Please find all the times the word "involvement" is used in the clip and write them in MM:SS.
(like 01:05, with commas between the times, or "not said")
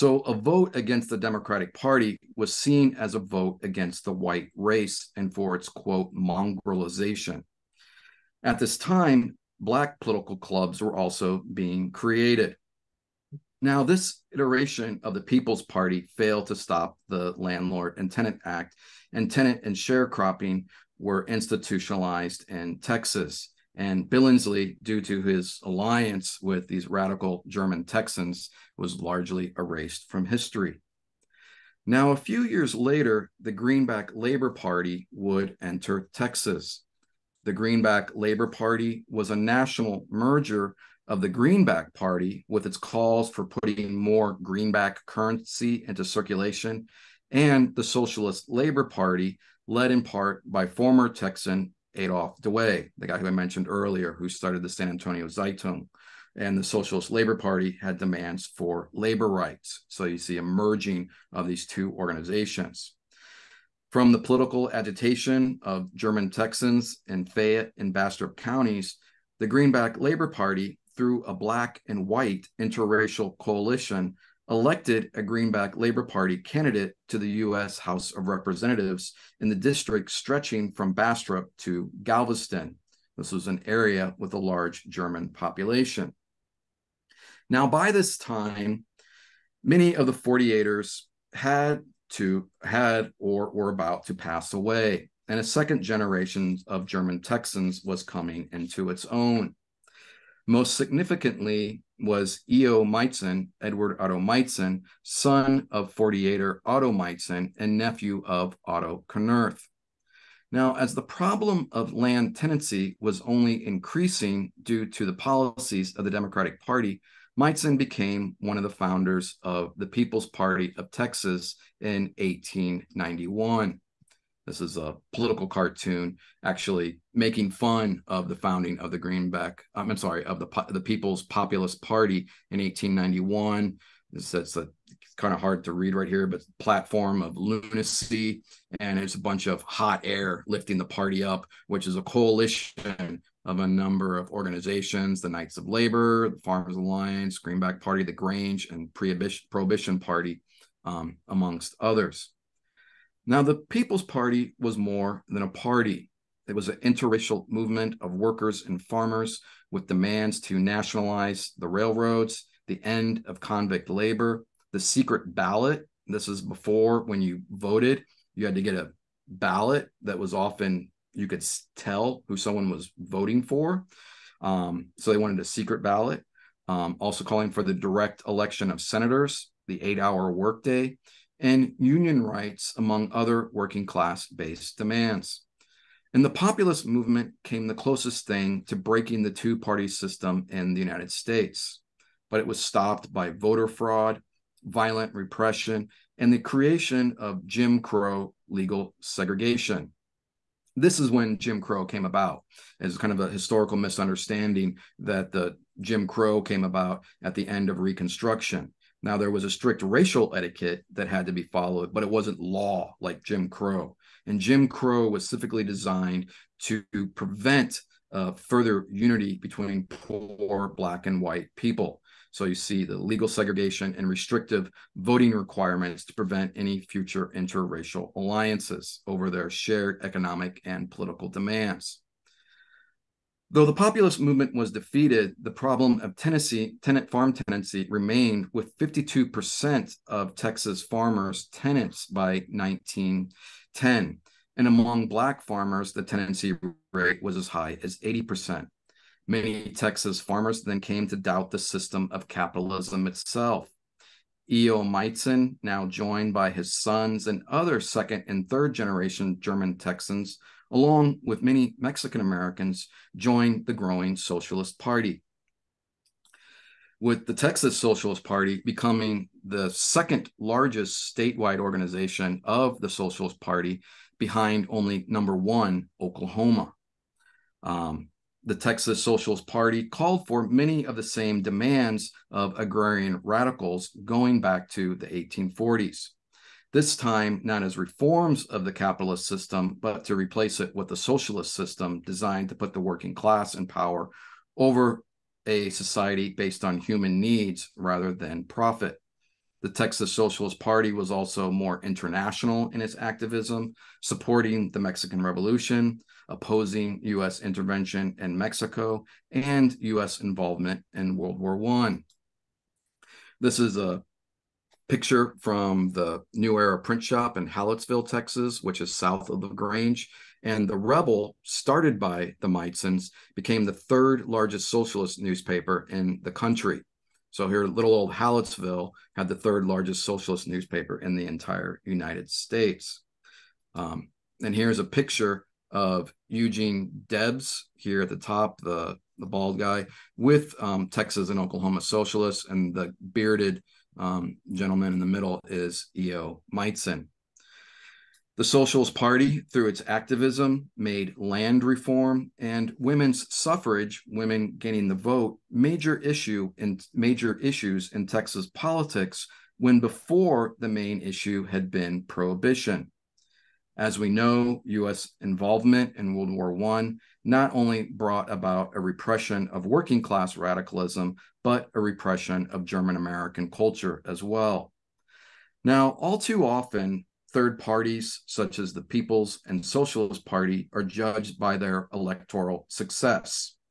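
05:10, 06:05.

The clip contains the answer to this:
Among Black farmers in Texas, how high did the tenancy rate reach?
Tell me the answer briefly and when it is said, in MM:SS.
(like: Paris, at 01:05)
80%, at 04:07.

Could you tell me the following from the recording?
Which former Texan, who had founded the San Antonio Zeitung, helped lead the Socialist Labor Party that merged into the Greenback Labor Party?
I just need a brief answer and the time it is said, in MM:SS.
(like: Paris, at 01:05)
Adolf Douai, at 00:51.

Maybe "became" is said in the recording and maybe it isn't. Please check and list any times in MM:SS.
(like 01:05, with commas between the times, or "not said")
01:57, 05:23.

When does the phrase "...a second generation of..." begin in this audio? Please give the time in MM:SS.
01:35.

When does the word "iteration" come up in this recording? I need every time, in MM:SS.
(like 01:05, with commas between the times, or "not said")
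00:14.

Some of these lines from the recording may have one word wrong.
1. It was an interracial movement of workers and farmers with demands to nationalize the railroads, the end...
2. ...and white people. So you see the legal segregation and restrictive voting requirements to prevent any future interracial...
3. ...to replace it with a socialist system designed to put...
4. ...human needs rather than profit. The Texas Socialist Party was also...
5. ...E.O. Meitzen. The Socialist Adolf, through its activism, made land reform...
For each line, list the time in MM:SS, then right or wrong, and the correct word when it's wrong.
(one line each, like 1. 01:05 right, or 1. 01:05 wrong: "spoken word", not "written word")
1. 02:36 right
2. 03:41 right
3. 04:50 right
4. 04:56 right
5. 05:45 wrong: "Party", not "Adolf".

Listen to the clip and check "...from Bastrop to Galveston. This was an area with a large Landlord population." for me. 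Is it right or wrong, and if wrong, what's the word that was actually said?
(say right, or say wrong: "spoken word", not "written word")
wrong: "German", not "Landlord".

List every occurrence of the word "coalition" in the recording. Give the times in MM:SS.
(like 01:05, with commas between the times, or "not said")
01:13, 02:22.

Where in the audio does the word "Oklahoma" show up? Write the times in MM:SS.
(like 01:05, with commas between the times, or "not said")
04:35, 05:41.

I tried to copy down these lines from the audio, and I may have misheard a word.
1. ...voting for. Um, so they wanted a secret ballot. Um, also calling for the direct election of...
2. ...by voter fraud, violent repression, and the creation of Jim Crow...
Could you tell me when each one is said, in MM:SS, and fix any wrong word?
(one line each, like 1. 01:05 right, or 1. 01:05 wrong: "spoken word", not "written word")
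1. 02:52 right
2. 03:13 right.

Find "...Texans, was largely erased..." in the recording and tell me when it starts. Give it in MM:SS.
00:27.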